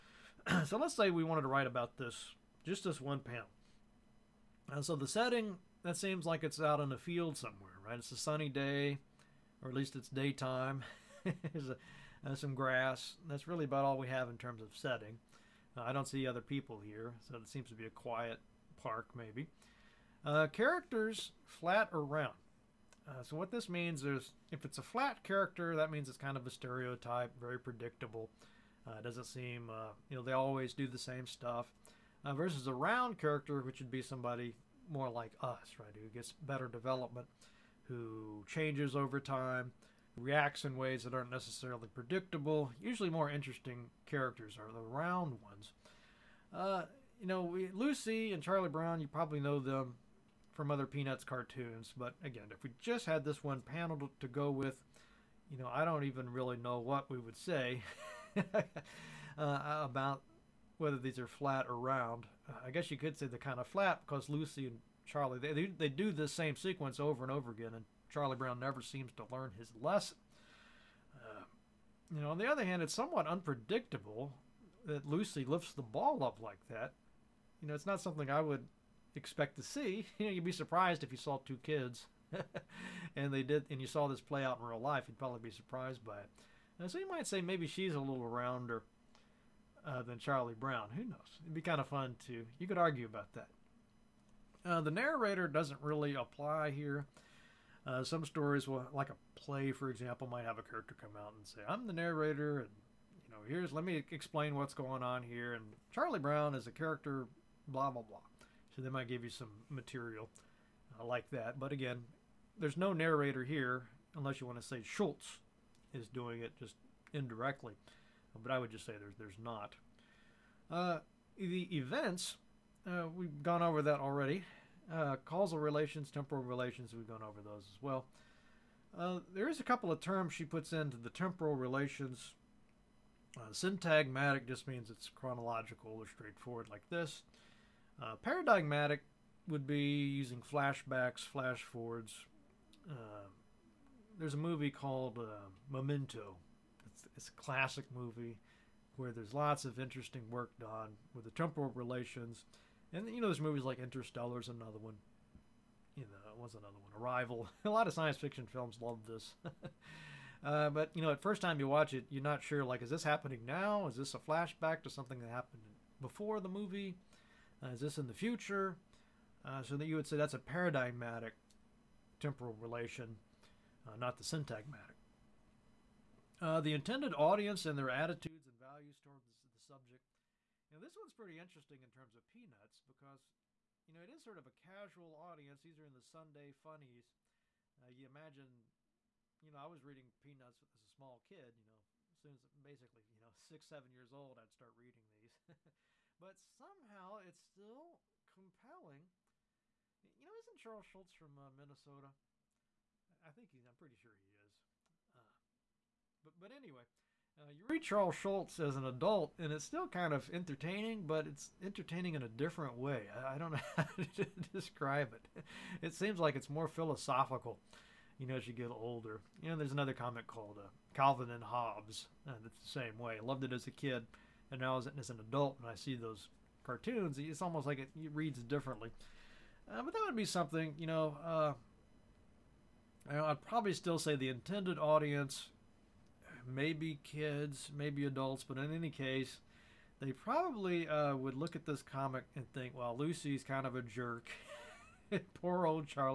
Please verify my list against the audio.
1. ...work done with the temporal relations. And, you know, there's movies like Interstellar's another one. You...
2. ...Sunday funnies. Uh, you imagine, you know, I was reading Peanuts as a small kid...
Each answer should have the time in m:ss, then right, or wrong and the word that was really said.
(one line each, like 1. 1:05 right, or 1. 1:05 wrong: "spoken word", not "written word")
1. 2:30 right
2. 3:06 right.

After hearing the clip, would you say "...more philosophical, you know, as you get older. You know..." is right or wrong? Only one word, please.
right.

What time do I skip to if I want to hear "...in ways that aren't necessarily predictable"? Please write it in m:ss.
0:40.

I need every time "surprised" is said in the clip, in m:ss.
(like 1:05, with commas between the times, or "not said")
1:20, 1:25.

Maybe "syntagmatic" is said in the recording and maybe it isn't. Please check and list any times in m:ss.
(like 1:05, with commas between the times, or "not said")
2:13, 2:54.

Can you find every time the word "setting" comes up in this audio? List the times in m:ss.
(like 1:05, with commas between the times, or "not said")
0:05, 0:14.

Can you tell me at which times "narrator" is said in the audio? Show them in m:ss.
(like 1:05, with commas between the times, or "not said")
1:34, 1:41, 1:52.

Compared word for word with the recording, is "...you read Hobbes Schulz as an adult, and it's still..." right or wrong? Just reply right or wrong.
wrong.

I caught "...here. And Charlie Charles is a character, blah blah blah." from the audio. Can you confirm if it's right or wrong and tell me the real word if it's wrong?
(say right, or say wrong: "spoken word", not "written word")
wrong: "Brown", not "Charles".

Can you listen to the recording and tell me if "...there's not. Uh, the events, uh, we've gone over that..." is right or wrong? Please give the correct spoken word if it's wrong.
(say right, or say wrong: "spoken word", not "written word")
right.